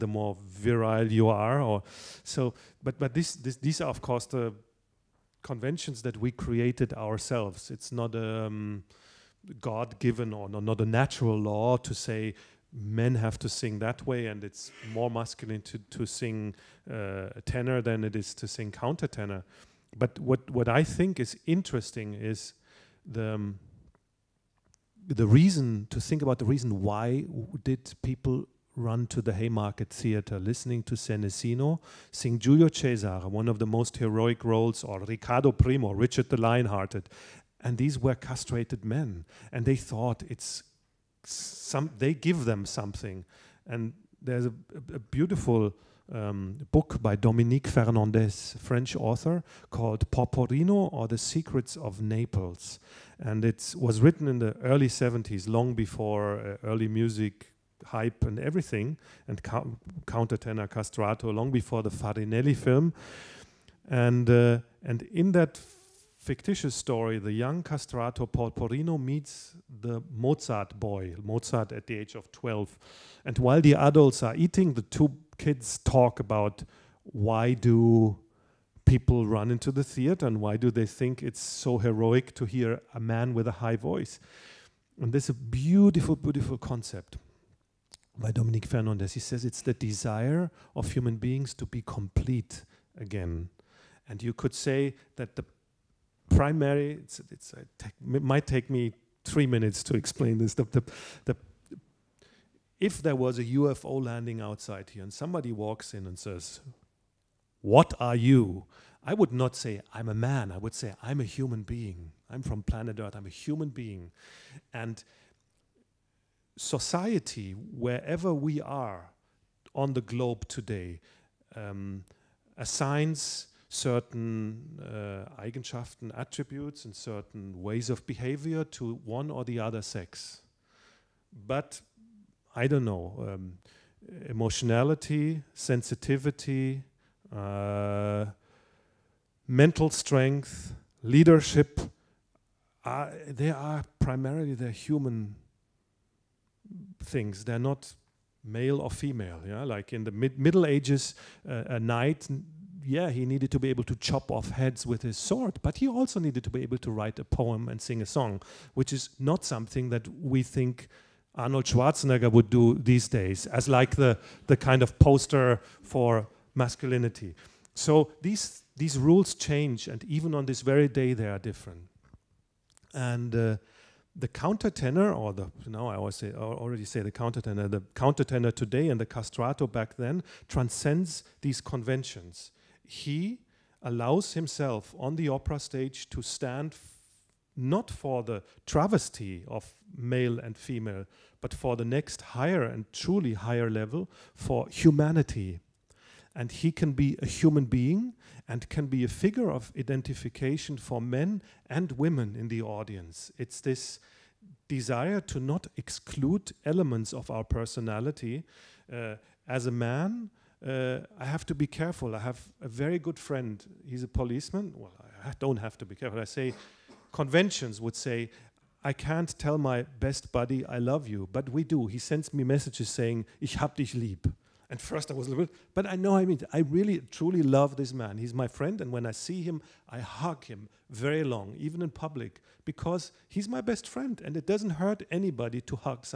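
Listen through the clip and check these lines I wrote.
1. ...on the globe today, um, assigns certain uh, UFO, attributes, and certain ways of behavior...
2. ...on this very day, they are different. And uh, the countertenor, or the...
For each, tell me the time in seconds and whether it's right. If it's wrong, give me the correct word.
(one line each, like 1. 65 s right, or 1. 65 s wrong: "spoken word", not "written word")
1. 119 s wrong: "Eigenschaften", not "UFO"
2. 170 s right.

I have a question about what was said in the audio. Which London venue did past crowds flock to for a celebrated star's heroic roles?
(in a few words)
Haymarket Theatre.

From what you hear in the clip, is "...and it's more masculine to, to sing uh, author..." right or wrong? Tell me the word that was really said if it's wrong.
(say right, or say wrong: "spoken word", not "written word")
wrong: "tenor", not "author".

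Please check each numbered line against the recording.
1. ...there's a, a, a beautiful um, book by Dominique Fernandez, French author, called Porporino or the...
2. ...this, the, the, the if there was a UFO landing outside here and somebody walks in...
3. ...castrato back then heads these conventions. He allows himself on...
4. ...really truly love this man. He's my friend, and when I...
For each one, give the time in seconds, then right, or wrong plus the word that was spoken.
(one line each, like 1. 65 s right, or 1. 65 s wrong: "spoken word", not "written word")
1. 44 s right
2. 100 s right
3. 179 s wrong: "transcends", not "heads"
4. 226 s right.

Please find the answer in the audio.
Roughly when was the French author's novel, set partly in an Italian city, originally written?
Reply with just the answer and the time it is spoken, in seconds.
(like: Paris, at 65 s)
Early 70s, at 54 s.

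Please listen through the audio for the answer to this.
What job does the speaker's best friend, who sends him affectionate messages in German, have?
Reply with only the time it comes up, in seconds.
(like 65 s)
214 s.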